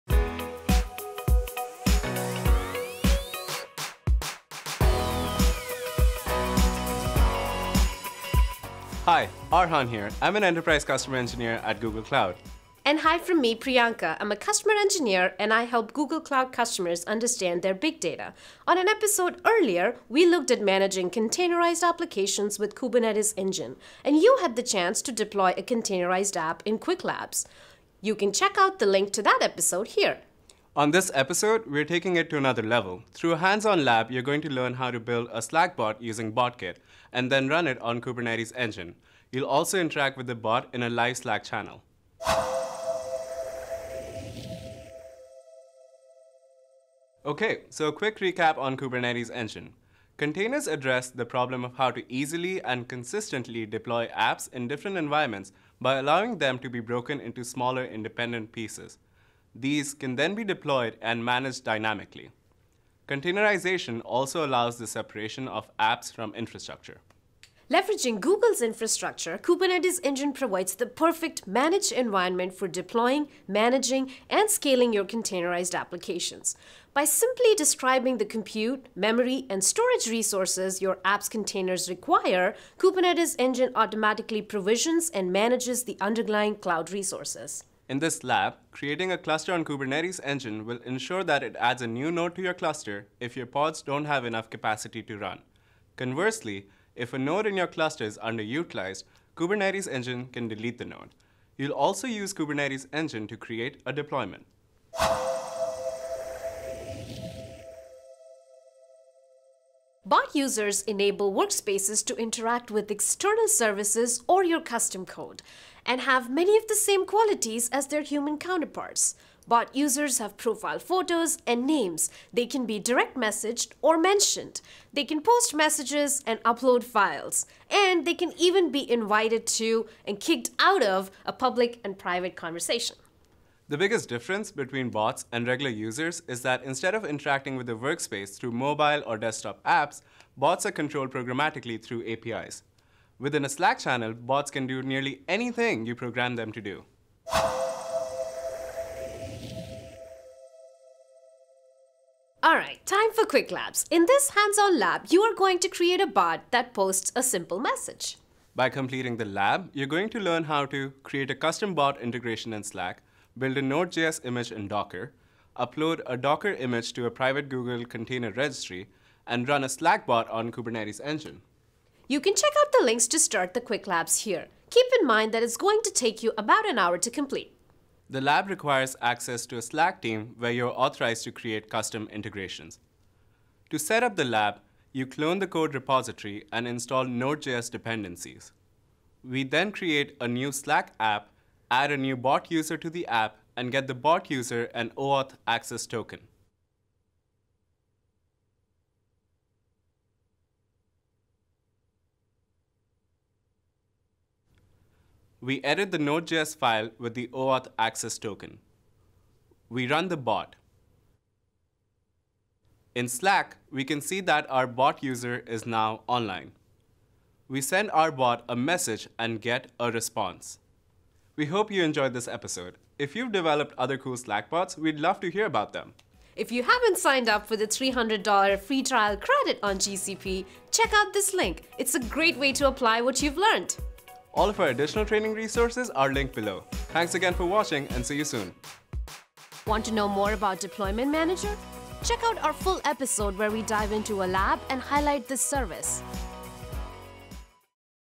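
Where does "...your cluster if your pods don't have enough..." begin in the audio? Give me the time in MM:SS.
01:32.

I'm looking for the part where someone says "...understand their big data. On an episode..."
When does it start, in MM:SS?
00:17.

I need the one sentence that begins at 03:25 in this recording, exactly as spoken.
We edit the Node.js file with the OAuth access token.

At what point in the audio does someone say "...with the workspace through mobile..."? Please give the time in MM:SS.
02:17.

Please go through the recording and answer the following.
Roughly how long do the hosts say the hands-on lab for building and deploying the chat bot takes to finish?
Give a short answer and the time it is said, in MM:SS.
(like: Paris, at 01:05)
about an hour, at 02:56.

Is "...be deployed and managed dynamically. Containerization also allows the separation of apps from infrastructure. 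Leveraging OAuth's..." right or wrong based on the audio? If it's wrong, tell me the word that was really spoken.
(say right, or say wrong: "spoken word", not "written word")
wrong: "Google", not "OAuth".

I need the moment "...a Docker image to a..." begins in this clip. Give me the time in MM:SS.
02:46.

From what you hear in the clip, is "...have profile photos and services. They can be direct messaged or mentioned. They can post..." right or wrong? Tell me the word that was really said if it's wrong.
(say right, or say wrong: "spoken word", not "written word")
wrong: "names", not "services".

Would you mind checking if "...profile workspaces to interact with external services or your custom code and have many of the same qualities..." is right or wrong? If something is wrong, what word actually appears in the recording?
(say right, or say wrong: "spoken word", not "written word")
wrong: "enable", not "profile".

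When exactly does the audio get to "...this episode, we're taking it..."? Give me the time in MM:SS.
00:30.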